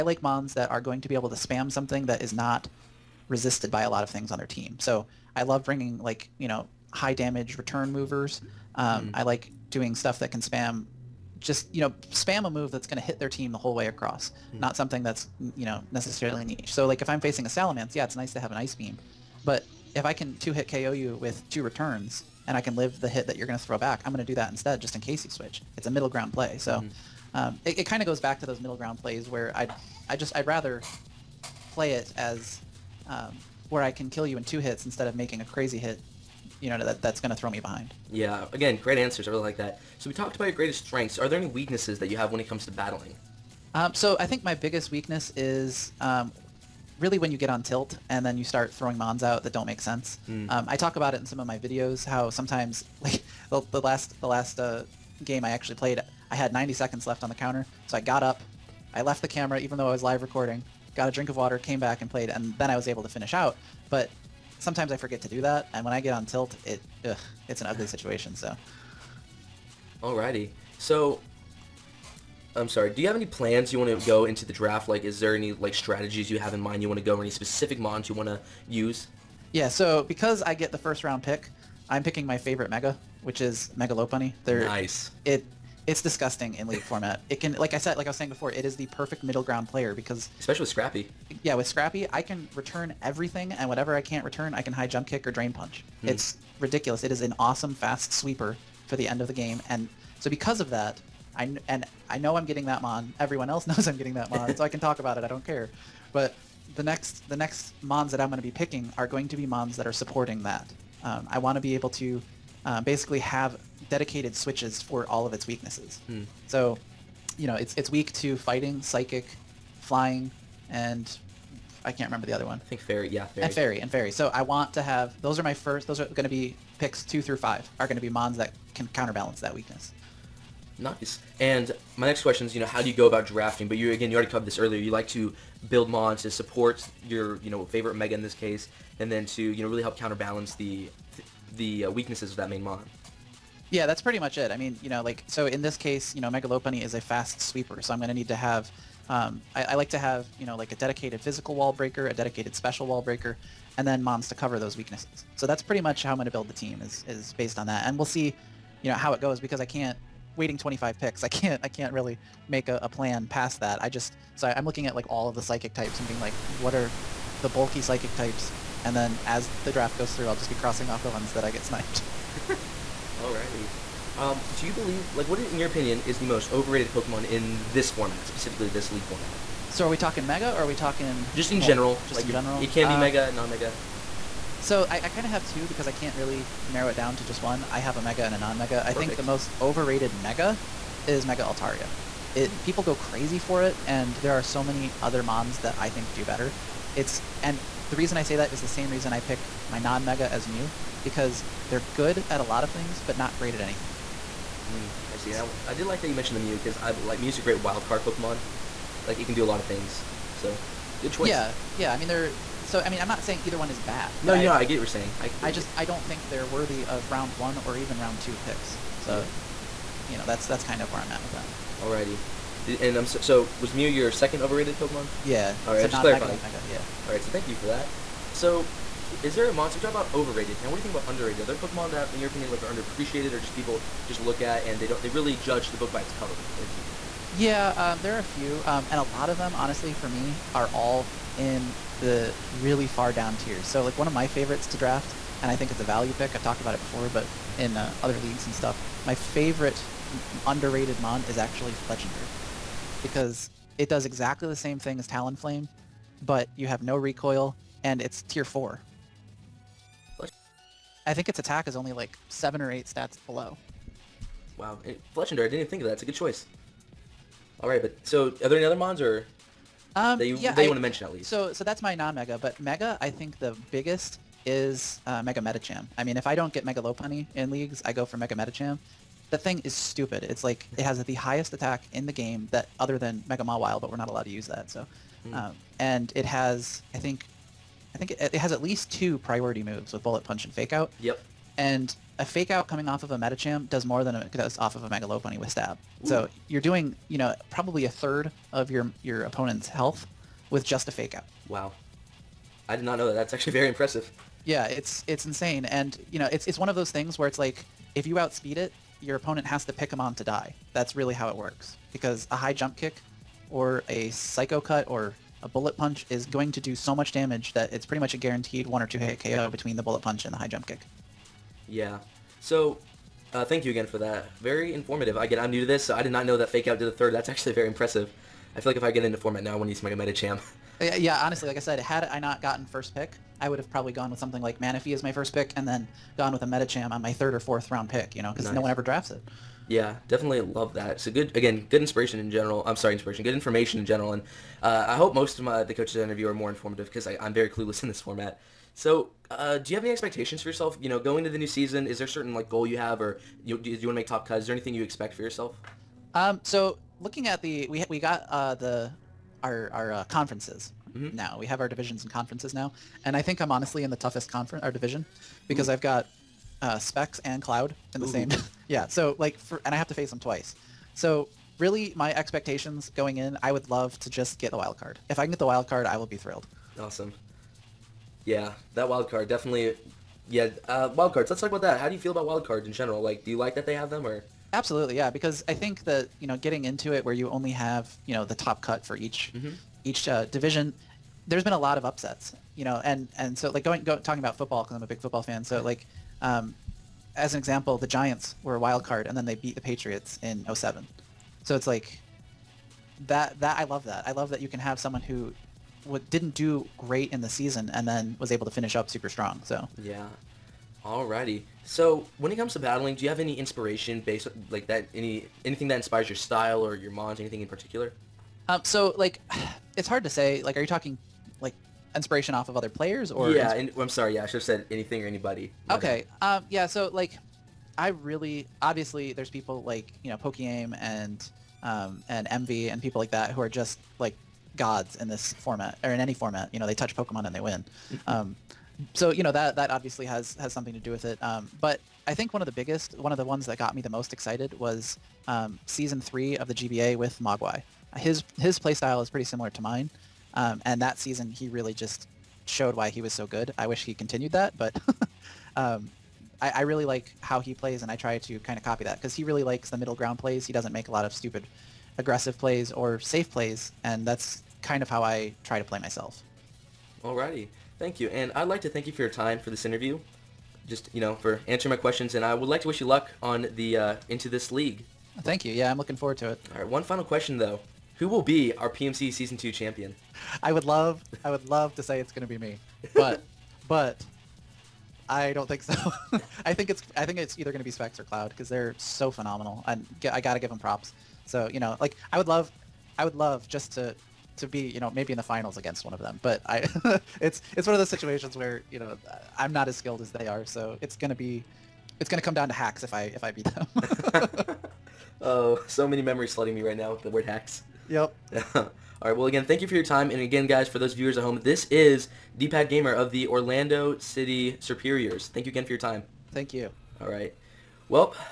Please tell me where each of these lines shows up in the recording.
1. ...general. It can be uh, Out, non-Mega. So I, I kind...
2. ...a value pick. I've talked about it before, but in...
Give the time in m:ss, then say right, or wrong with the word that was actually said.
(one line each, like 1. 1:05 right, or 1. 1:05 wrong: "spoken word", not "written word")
1. 3:02 wrong: "Mega", not "Out"
2. 4:05 right.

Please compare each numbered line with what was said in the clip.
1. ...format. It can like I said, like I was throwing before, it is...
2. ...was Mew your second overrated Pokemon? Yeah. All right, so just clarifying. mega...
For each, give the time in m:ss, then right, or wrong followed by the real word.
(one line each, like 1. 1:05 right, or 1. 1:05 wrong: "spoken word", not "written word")
1. 1:26 wrong: "saying", not "throwing"
2. 3:43 right.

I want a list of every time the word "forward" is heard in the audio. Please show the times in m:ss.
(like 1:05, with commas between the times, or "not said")
7:55.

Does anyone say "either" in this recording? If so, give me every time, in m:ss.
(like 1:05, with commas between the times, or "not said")
3:33, 8:07.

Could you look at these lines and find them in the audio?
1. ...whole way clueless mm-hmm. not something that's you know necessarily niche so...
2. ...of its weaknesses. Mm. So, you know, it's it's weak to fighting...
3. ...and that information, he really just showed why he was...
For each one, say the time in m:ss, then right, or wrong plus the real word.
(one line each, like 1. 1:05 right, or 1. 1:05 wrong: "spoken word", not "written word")
1. 0:13 wrong: "across", not "clueless"
2. 1:55 right
3. 7:30 wrong: "season", not "information".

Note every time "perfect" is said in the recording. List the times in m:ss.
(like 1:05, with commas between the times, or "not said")
1:28.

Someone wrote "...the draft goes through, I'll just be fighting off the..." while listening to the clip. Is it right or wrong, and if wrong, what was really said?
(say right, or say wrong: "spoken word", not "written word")
wrong: "crossing", not "fighting".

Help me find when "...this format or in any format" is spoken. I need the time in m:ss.
7:15.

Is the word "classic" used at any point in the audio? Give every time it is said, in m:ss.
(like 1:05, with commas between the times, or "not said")
not said.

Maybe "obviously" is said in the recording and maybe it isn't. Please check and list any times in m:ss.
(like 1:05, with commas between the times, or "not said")
7:08, 7:19.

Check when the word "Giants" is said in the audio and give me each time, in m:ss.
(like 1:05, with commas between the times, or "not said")
6:37.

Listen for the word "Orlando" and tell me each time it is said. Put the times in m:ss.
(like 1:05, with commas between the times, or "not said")
8:33.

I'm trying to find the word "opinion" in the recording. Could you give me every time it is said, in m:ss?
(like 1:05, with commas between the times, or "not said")
2:55, 3:52.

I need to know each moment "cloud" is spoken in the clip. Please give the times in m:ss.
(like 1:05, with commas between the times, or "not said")
6:07, 8:08.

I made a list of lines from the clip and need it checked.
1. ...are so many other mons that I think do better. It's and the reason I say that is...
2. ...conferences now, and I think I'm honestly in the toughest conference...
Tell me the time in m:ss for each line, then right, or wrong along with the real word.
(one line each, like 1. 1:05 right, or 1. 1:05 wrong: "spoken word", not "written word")
1. 3:14 right
2. 6:02 right.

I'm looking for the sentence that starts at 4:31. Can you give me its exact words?
So so that's my non-mega, but mega, I think the biggest is uh, Mega Medicham.